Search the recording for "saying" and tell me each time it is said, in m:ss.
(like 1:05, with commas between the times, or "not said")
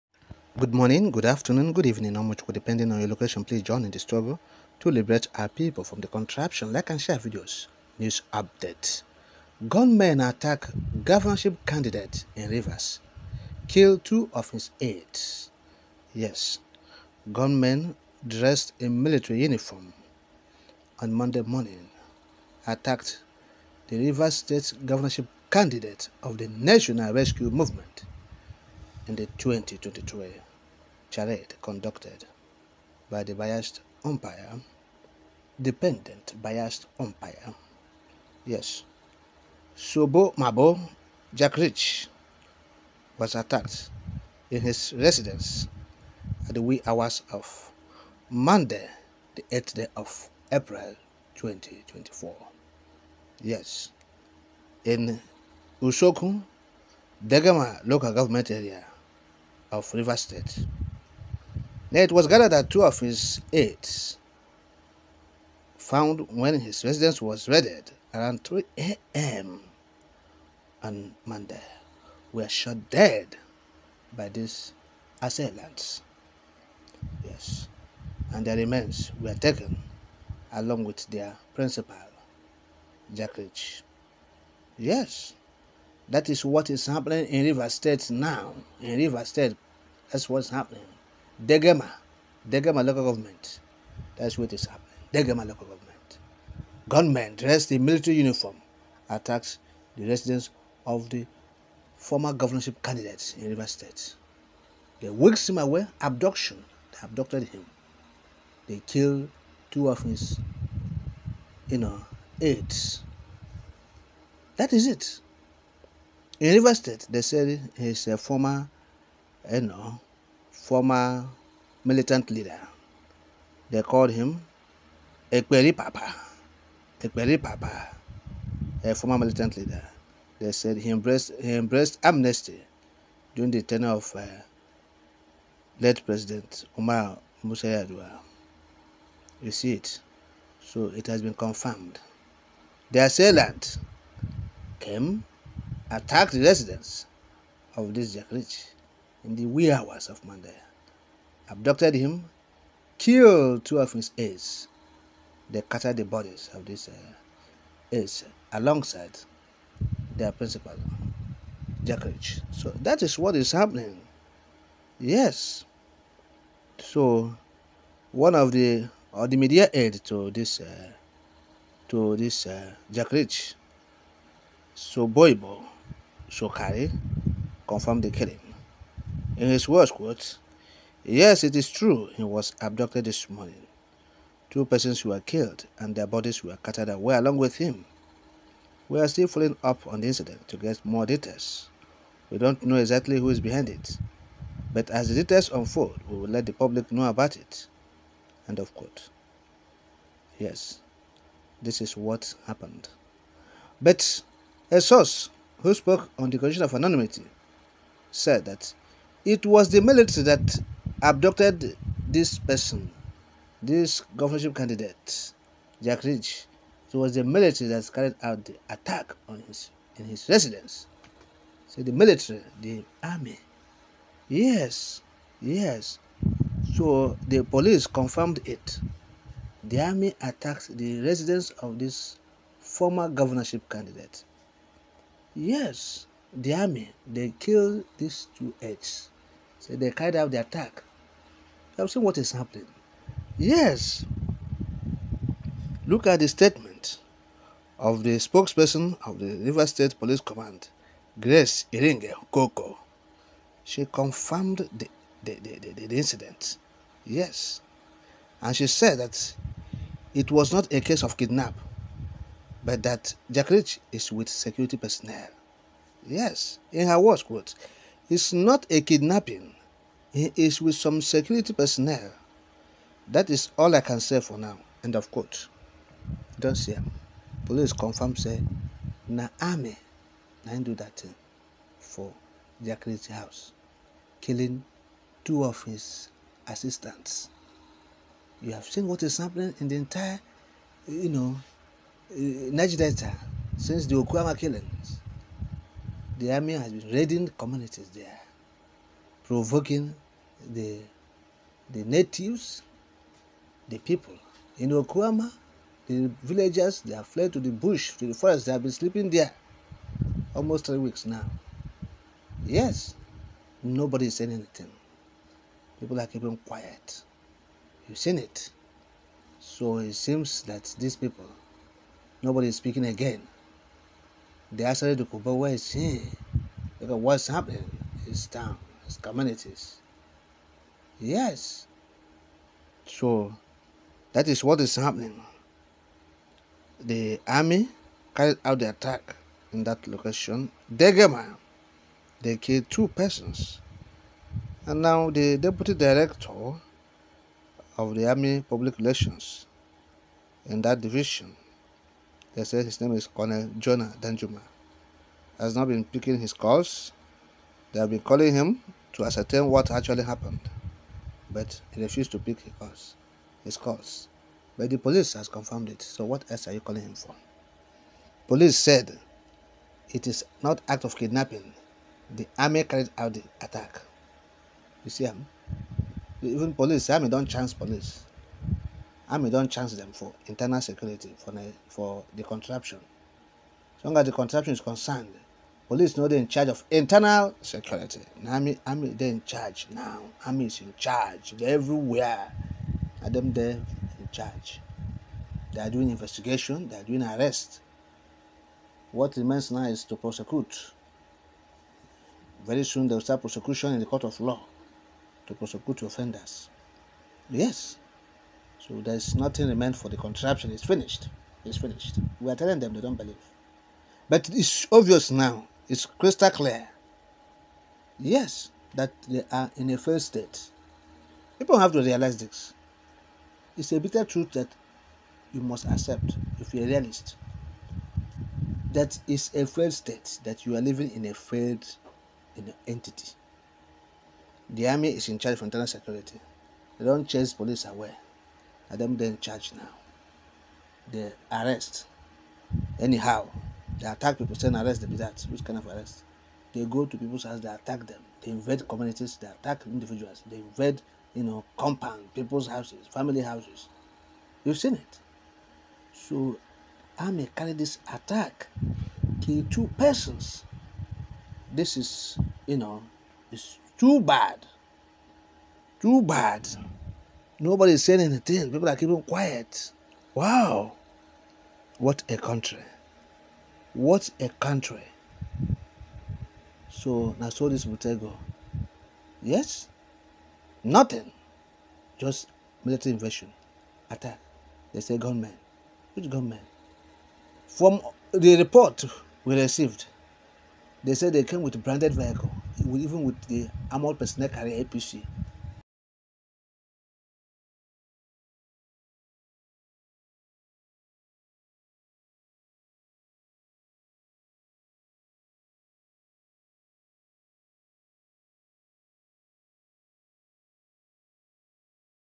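5:14, 7:47.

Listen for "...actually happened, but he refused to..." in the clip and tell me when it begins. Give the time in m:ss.
5:59.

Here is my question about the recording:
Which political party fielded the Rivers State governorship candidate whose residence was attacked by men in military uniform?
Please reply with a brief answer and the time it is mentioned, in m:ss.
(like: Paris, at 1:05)
National Rescue Movement, at 0:26.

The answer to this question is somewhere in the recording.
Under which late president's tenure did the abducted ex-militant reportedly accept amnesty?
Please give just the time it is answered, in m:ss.
2:16.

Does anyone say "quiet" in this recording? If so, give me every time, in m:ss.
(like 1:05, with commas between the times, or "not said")
5:16, 7:49.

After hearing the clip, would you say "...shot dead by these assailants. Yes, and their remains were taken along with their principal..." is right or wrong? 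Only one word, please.
right.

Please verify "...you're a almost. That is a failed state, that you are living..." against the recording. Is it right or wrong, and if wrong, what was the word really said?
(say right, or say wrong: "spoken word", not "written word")
wrong: "realist", not "almost".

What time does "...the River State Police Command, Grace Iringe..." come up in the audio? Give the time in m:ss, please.
4:09.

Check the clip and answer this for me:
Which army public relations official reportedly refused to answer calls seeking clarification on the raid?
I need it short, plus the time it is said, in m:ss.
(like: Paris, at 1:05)
Colonel Jonah Danjuma, at 5:53.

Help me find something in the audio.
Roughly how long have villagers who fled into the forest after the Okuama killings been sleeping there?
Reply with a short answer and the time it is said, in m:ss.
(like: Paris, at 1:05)
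almost three weeks, at 5:10.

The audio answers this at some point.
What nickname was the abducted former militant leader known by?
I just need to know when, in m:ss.
2:03.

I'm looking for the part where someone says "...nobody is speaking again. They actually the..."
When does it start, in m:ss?
5:22.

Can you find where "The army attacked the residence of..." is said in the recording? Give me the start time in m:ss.
3:49.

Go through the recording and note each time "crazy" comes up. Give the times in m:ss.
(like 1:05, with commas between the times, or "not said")
4:42.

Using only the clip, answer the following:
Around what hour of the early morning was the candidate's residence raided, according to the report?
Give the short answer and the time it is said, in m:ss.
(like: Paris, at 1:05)
3 a.m., at 1:08.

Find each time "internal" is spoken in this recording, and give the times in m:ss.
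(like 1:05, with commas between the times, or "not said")
6:20, 6:26, 7:15.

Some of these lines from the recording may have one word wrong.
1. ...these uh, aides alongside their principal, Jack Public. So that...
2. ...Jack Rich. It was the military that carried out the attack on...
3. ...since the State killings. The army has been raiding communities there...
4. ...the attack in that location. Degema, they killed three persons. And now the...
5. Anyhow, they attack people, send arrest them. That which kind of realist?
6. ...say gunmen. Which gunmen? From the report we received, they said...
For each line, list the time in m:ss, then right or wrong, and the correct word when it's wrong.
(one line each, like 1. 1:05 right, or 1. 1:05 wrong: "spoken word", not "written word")
1. 2:36 wrong: "Rich", not "Public"
2. 3:35 right
3. 4:53 wrong: "Okuama", not "State"
4. 5:38 wrong: "two", not "three"
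5. 7:22 wrong: "arrest", not "realist"
6. 8:04 right.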